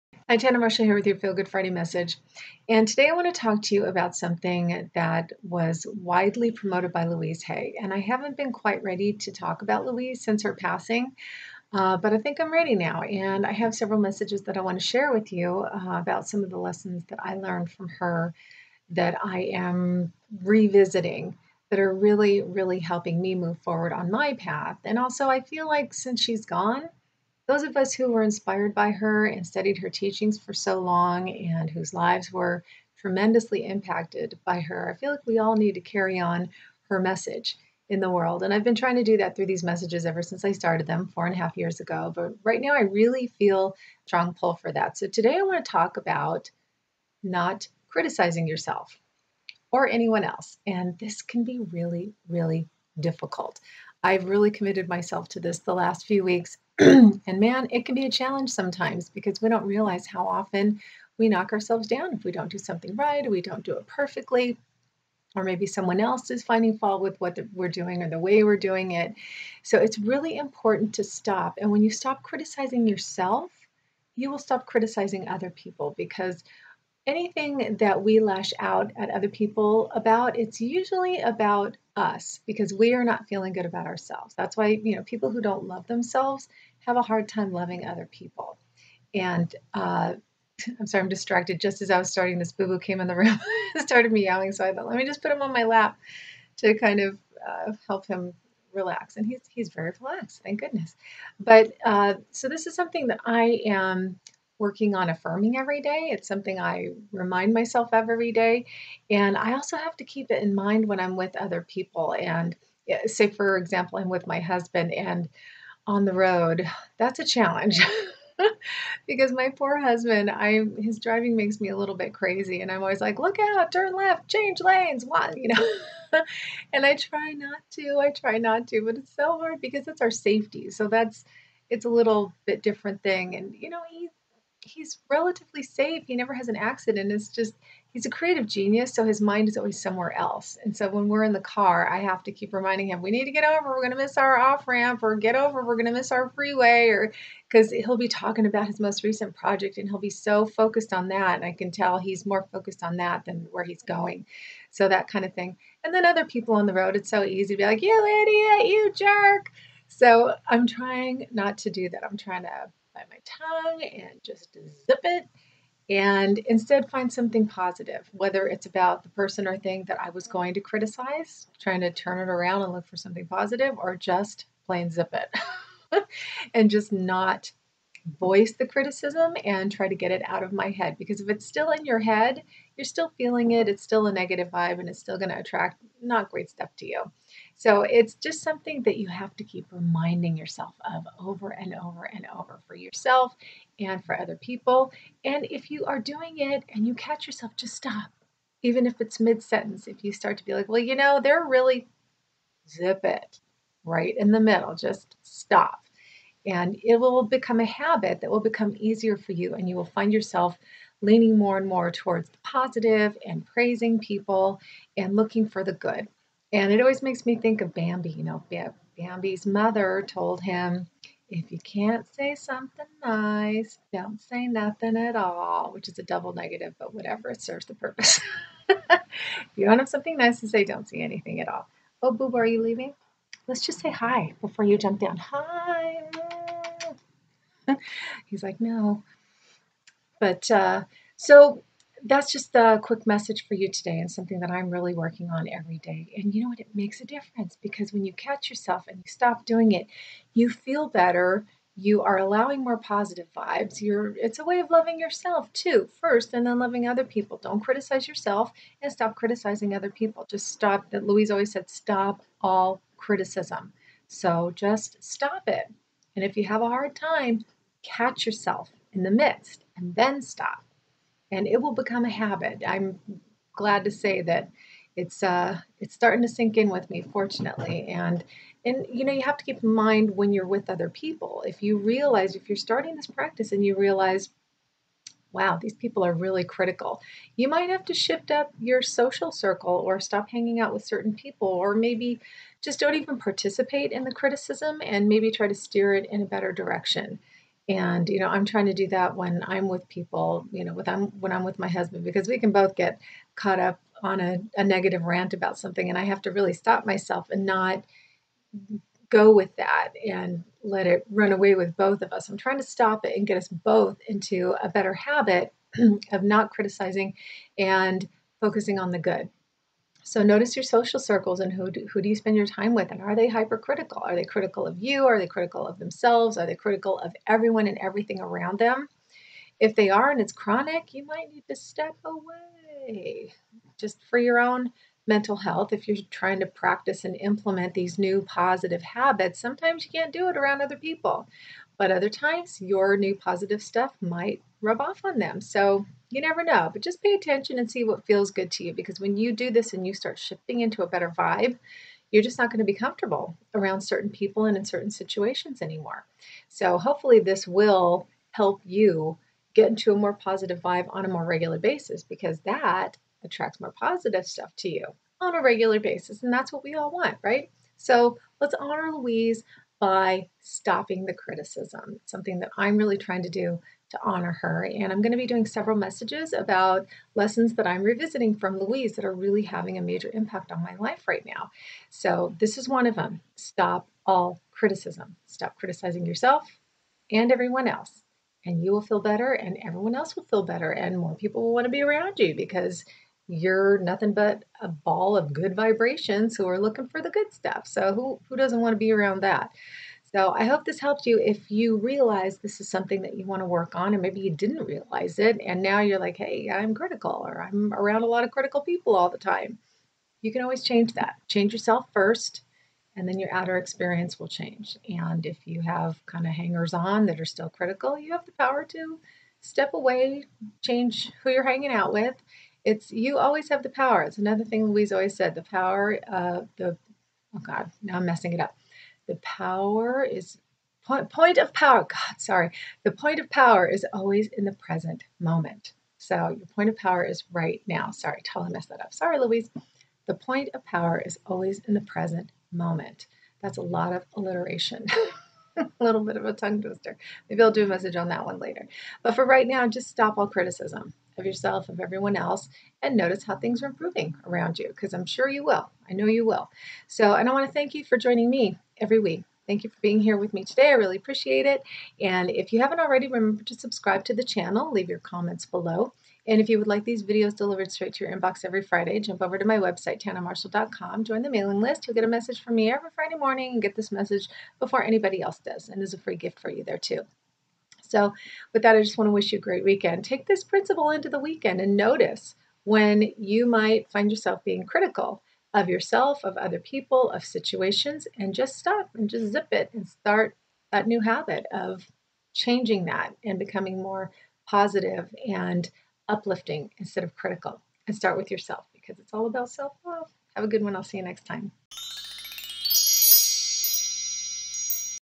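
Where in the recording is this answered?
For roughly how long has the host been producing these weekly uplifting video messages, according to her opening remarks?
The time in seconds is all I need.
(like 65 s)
41 s.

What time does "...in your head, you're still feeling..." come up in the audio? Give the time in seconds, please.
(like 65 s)
181 s.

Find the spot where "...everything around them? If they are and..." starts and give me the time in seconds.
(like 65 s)
327 s.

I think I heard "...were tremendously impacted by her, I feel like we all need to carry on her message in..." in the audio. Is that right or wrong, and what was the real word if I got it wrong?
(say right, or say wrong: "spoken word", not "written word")
right.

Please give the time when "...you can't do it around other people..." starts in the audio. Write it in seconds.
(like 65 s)
339 s.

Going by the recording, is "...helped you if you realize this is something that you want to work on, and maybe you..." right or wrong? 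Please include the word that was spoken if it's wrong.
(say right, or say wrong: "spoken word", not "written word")
right.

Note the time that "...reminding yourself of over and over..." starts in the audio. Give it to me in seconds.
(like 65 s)
189 s.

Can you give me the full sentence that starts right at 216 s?
And it always makes me think of Bambi.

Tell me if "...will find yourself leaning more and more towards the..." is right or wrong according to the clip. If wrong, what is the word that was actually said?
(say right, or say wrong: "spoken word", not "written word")
right.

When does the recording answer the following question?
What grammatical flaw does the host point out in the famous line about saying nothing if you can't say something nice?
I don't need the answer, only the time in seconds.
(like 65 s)
226 s.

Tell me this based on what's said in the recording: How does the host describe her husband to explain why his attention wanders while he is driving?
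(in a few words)
a creative genius.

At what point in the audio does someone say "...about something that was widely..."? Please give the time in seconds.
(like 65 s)
3 s.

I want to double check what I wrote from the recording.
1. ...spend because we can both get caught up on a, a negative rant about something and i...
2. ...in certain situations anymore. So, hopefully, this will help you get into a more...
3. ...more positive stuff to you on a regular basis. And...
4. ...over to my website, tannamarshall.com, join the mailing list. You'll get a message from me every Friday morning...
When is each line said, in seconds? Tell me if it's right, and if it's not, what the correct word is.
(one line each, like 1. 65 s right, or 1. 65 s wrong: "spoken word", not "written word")
1. 301 s wrong: "husband", not "spend"
2. 354 s right
3. 363 s right
4. 469 s right.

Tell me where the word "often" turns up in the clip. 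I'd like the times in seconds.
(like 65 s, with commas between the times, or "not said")
60 s.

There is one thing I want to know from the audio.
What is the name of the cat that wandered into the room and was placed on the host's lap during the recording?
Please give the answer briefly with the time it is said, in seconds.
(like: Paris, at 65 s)
Boo Boo, at 92 s.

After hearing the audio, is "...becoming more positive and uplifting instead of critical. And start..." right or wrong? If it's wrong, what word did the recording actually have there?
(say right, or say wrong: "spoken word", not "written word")
right.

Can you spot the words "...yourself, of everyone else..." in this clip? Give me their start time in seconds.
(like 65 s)
451 s.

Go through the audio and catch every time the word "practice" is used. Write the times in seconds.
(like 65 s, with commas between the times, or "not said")
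283 s, 336 s.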